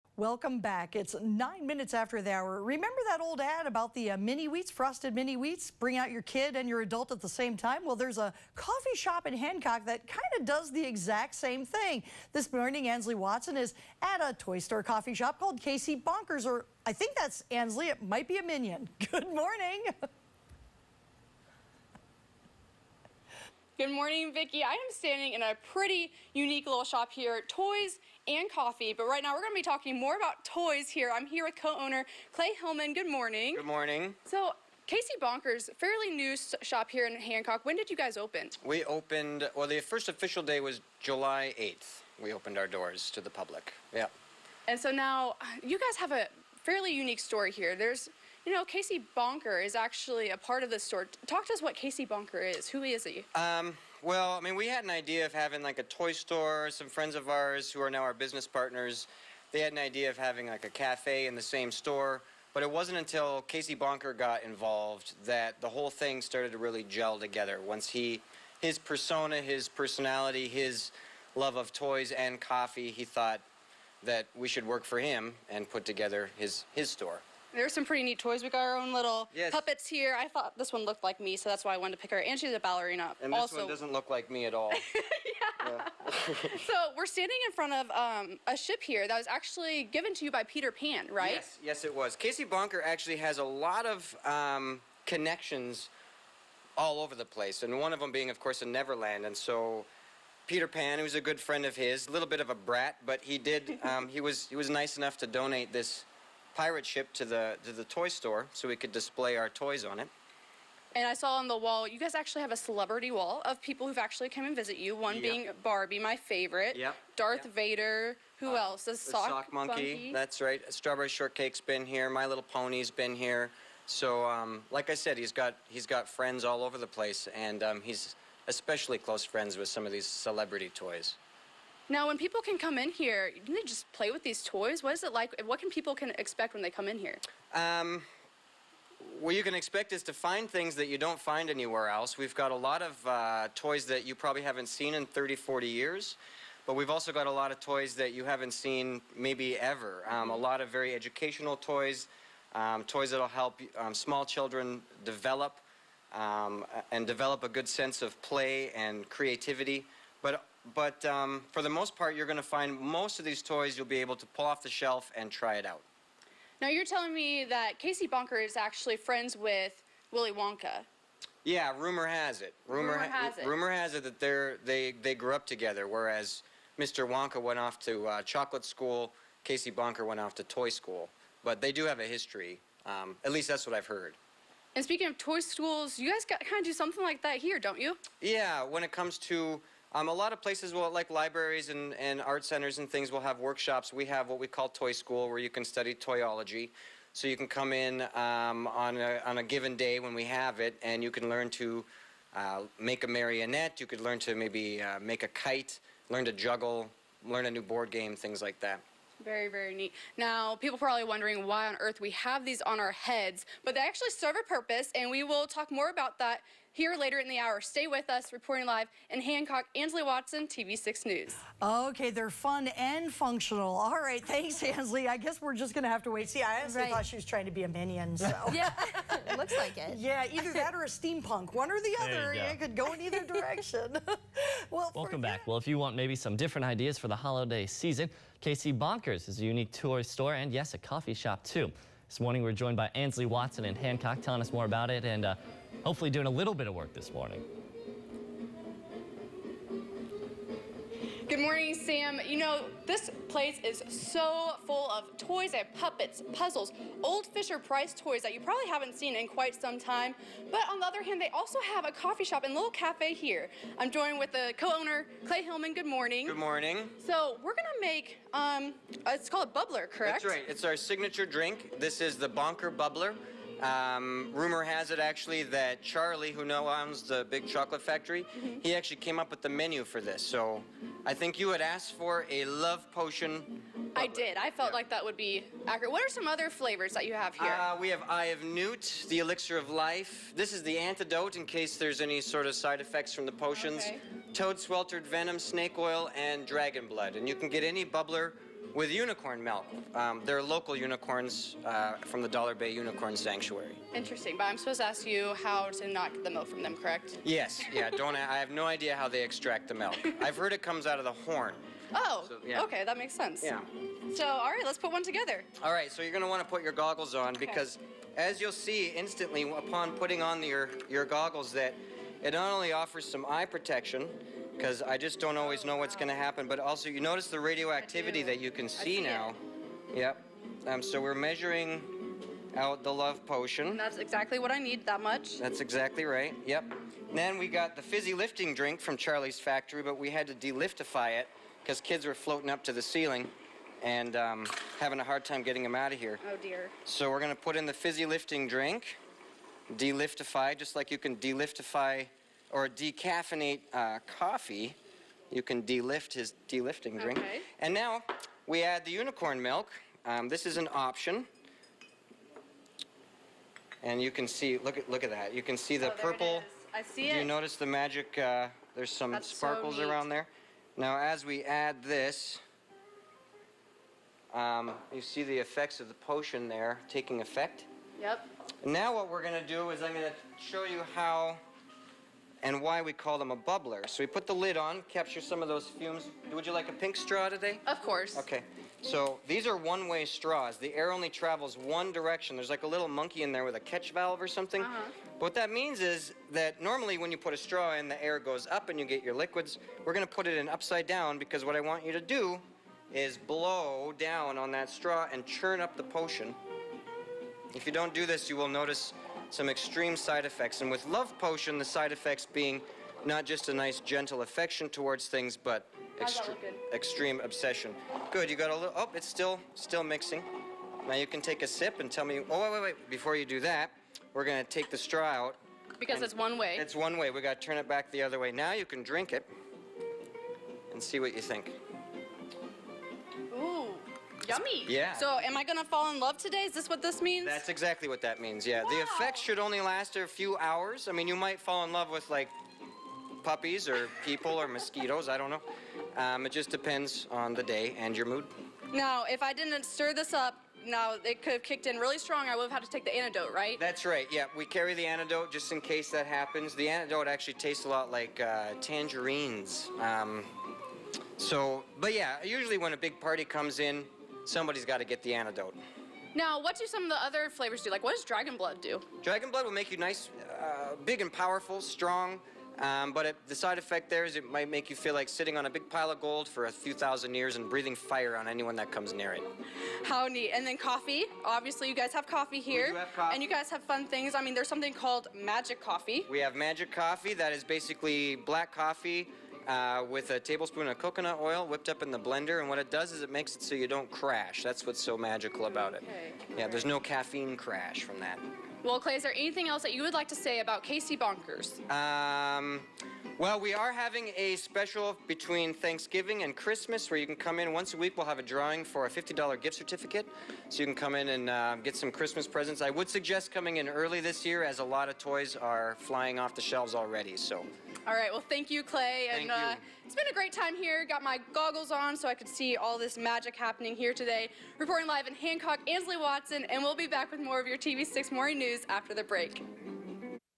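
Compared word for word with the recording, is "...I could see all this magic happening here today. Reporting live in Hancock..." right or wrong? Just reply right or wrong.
right.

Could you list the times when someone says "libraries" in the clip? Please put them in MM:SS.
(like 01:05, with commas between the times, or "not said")
03:11.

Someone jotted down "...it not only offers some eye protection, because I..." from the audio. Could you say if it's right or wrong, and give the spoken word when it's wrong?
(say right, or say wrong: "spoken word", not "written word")
right.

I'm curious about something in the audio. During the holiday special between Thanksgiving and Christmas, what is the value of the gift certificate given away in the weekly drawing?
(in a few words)
$50.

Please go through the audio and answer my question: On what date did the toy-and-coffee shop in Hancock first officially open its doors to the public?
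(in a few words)
July 8.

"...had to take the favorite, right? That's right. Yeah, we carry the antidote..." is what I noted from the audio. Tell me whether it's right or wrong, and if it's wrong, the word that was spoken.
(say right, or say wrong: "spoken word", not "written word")
wrong: "antidote", not "favorite".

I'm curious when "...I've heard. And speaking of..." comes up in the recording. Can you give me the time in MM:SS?
03:03.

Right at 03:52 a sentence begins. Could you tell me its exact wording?
You, it could go in either direction.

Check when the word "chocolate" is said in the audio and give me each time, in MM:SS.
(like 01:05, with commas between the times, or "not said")
02:58, 04:37.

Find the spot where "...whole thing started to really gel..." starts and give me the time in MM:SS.
01:05.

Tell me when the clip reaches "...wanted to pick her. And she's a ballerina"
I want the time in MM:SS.
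01:21.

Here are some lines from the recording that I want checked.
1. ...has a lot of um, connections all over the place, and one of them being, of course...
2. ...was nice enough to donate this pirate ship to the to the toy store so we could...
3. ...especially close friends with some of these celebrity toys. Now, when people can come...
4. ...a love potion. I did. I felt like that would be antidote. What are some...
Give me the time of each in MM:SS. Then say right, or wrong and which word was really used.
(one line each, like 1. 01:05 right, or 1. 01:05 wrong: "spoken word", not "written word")
1. 01:33 right
2. 01:44 right
3. 02:08 right
4. 04:42 wrong: "accurate", not "antidote".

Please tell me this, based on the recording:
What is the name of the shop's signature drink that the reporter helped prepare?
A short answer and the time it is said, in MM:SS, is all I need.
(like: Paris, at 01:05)
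Bonker Bubbler, at 04:32.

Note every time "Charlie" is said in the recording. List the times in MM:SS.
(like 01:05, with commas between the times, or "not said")
04:35, 05:38.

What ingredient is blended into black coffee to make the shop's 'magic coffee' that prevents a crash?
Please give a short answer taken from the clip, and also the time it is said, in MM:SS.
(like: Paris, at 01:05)
coconut oil, at 08:10.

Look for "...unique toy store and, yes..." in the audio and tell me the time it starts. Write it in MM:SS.
03:59.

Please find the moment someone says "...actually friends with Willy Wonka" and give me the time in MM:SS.
02:48.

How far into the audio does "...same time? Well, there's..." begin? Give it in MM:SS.
00:07.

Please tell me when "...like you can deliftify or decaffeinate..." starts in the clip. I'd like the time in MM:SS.
05:50.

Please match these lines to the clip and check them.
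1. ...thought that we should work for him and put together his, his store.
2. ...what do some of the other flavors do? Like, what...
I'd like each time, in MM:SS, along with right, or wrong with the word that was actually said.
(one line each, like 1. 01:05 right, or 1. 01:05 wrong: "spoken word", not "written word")
1. 01:13 right
2. 07:46 right.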